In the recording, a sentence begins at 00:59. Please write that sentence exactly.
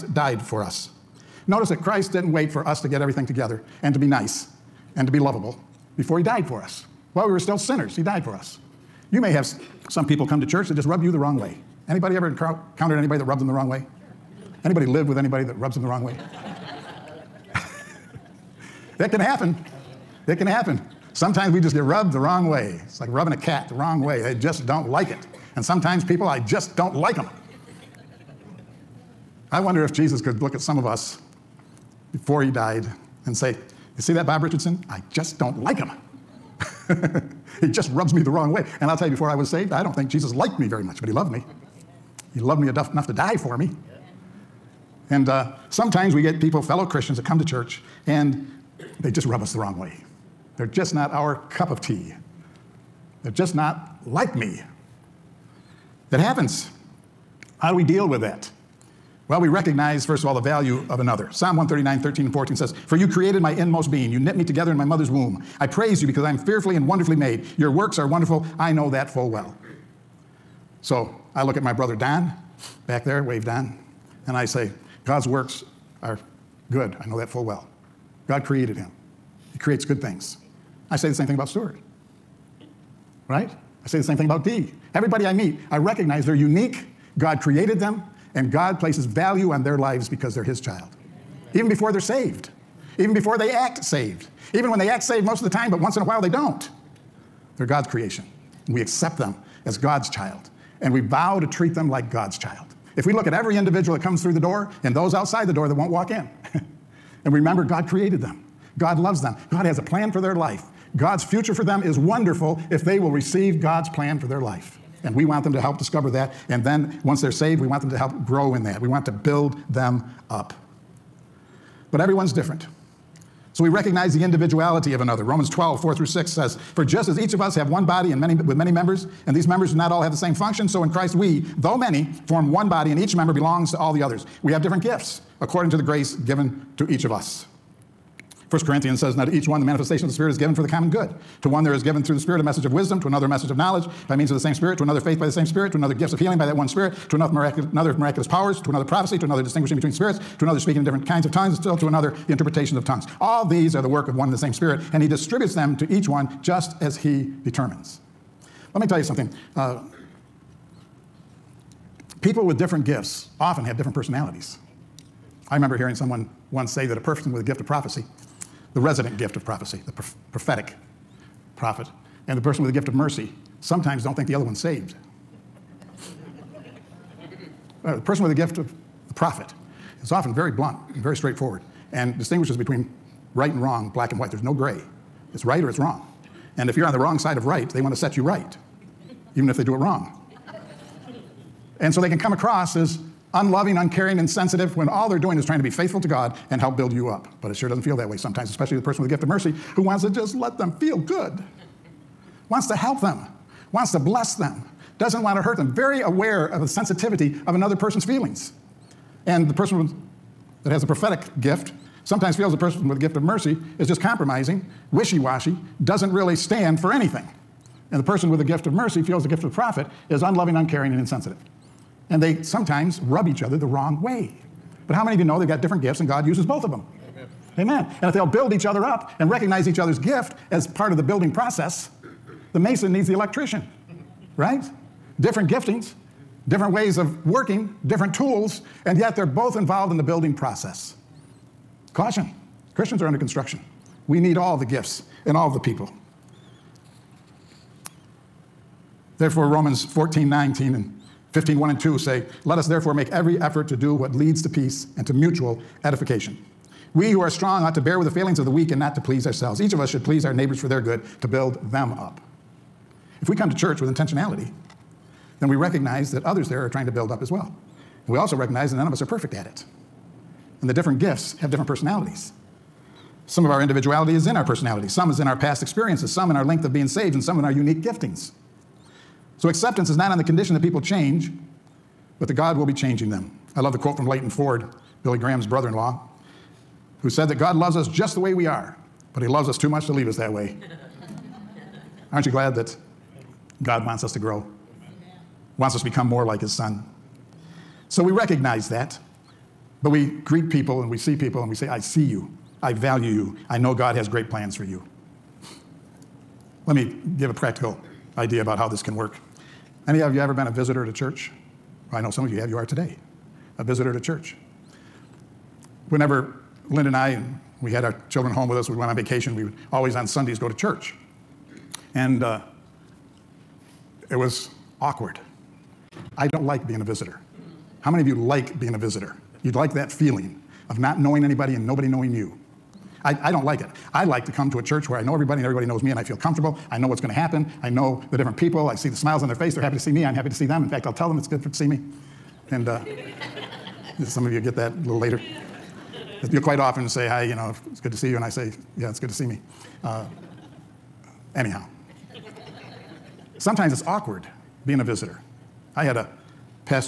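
Well, we recognize, first of all, the value of another.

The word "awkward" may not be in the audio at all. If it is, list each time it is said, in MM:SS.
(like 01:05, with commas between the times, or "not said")
05:24, 05:53.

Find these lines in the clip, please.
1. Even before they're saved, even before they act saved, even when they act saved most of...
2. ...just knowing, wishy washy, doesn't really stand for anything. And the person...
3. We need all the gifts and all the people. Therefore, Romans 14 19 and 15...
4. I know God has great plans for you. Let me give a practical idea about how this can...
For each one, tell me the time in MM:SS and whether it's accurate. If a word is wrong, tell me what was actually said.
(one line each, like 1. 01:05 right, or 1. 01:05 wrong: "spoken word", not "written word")
1. 01:31 right
2. 03:33 wrong: "compromising", not "knowing"
3. 04:04 right
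4. 05:03 right.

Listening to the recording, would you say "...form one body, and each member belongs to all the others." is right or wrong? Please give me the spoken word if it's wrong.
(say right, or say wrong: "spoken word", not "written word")
right.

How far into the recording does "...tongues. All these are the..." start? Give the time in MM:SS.
02:32.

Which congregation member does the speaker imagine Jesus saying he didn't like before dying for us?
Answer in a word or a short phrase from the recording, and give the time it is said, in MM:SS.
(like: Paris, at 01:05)
Bob Richardson, at 00:34.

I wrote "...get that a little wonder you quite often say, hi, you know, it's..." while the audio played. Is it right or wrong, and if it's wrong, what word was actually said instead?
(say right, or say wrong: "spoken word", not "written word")
wrong: "later", not "wonder".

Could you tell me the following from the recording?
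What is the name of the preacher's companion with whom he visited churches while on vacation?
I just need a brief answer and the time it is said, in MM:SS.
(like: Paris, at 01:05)
Linda, at 05:16.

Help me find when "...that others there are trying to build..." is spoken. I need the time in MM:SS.
04:26.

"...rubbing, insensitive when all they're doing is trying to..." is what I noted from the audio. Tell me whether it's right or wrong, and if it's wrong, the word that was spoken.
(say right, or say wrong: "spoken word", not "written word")
wrong: "uncaring", not "rubbing".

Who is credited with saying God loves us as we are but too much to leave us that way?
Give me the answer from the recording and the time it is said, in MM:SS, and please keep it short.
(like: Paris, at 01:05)
Leighton Ford, at 04:44.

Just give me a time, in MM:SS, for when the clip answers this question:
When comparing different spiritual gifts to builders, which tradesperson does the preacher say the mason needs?
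03:53.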